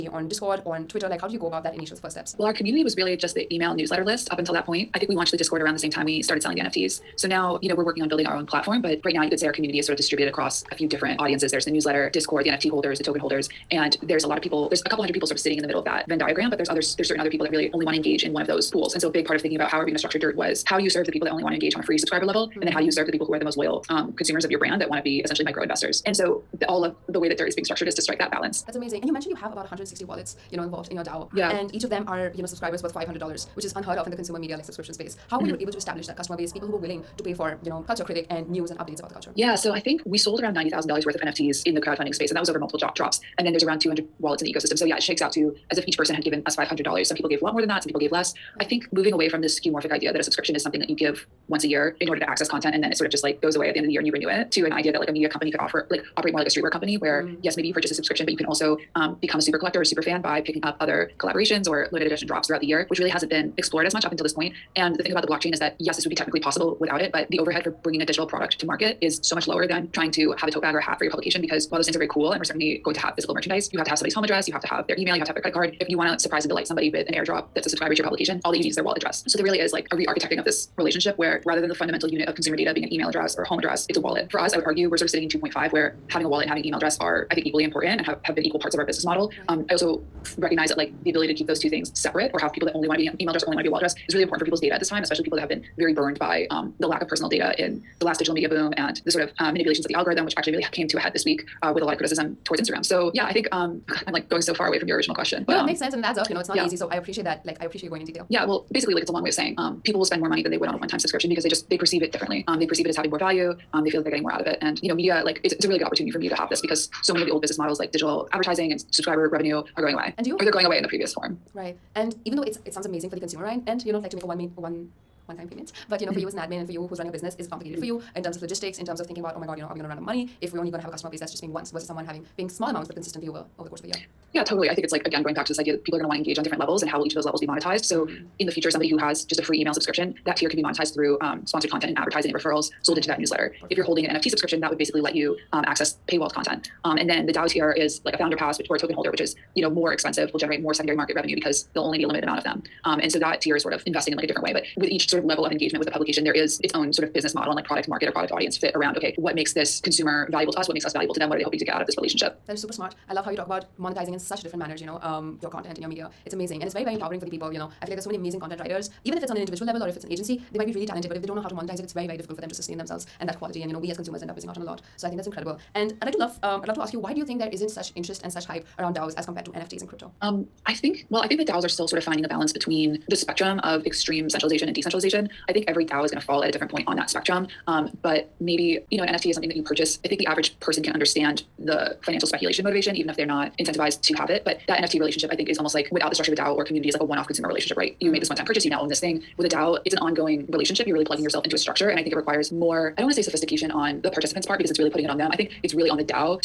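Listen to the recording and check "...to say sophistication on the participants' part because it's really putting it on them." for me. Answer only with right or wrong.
right.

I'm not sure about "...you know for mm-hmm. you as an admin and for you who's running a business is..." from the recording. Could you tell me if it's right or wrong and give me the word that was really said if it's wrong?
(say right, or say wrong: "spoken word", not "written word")
right.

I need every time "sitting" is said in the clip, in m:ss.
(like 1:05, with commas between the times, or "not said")
0:15, 1:25.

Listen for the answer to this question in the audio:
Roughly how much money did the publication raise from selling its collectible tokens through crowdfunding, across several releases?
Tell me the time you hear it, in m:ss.
0:40.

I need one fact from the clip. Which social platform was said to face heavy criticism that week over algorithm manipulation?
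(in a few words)
Instagram.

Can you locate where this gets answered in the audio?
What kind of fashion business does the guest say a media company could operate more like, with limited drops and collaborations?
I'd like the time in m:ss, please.
0:56.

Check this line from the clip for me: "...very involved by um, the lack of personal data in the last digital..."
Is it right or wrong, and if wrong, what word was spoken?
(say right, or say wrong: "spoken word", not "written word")
wrong: "burned", not "involved".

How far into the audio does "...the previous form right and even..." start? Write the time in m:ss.
2:00.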